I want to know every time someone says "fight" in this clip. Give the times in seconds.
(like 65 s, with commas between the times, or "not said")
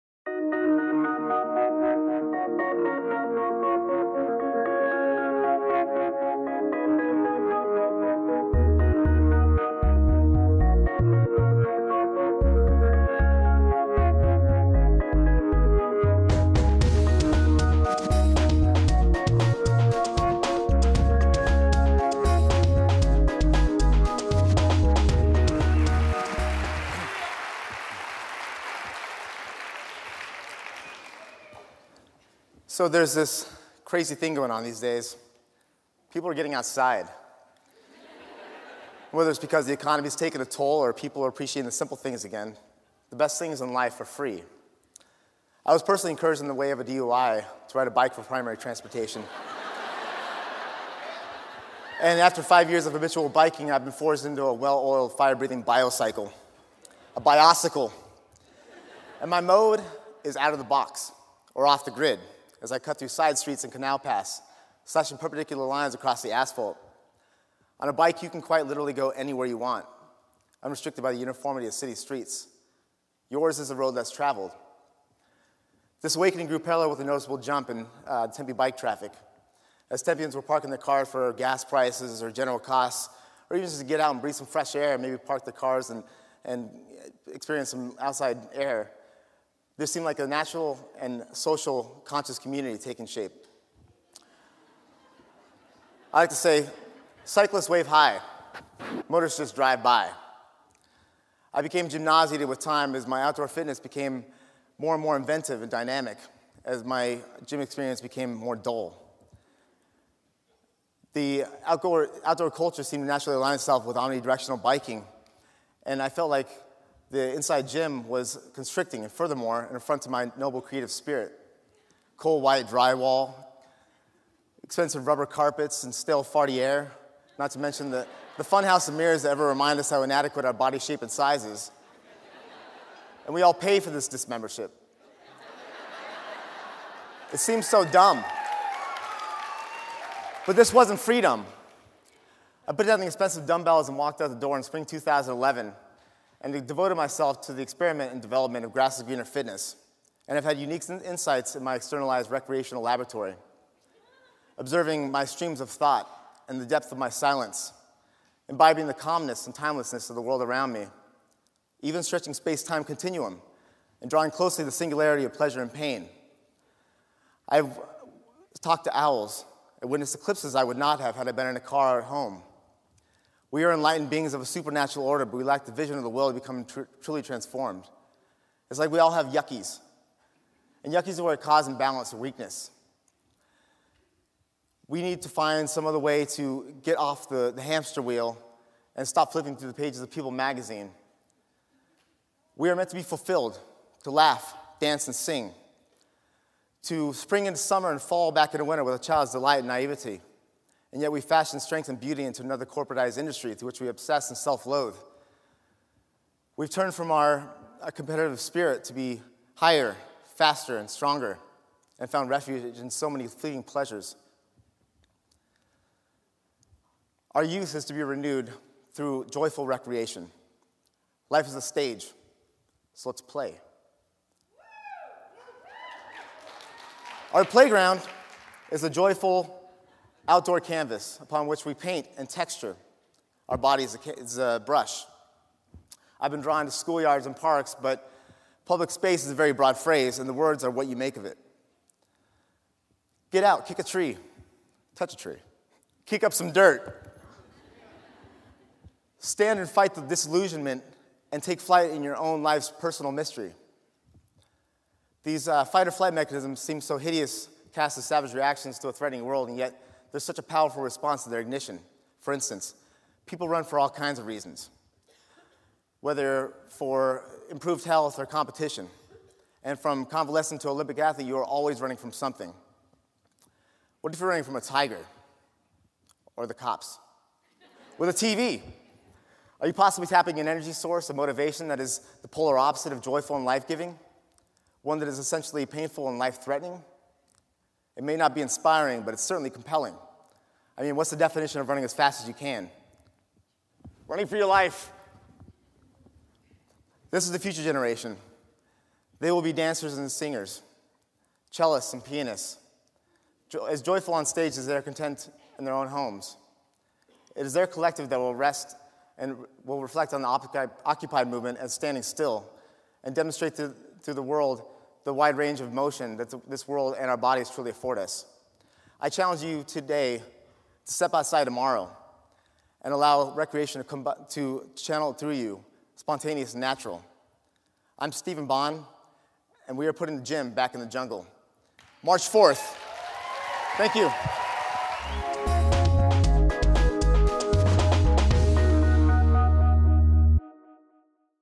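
249 s, 255 s.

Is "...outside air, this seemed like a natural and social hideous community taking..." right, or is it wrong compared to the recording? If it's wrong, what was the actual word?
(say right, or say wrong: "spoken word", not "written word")
wrong: "conscious", not "hideous".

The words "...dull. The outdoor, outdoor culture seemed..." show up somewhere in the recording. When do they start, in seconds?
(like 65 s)
108 s.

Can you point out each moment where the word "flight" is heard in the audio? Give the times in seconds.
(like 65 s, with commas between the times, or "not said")
251 s, 255 s.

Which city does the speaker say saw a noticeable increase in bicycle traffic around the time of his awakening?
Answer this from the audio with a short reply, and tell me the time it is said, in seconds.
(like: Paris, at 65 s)
Tempe, at 78 s.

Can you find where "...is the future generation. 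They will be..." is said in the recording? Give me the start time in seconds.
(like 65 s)
297 s.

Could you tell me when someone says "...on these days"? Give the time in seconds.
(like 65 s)
34 s.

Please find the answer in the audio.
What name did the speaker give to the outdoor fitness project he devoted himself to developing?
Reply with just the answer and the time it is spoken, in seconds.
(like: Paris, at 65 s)
Grasses Greener Fitness, at 148 s.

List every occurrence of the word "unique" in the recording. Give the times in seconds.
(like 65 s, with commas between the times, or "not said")
150 s.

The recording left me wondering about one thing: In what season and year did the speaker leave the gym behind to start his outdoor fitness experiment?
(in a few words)
spring 2011.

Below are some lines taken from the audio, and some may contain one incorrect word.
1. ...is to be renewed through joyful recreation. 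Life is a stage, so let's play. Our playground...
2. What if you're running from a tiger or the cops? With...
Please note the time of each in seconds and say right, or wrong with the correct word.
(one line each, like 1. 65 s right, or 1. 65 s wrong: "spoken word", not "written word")
1. 217 s right
2. 274 s right.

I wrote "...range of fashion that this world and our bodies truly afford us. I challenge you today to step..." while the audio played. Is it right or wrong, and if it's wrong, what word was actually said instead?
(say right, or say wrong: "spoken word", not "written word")
wrong: "motion", not "fashion".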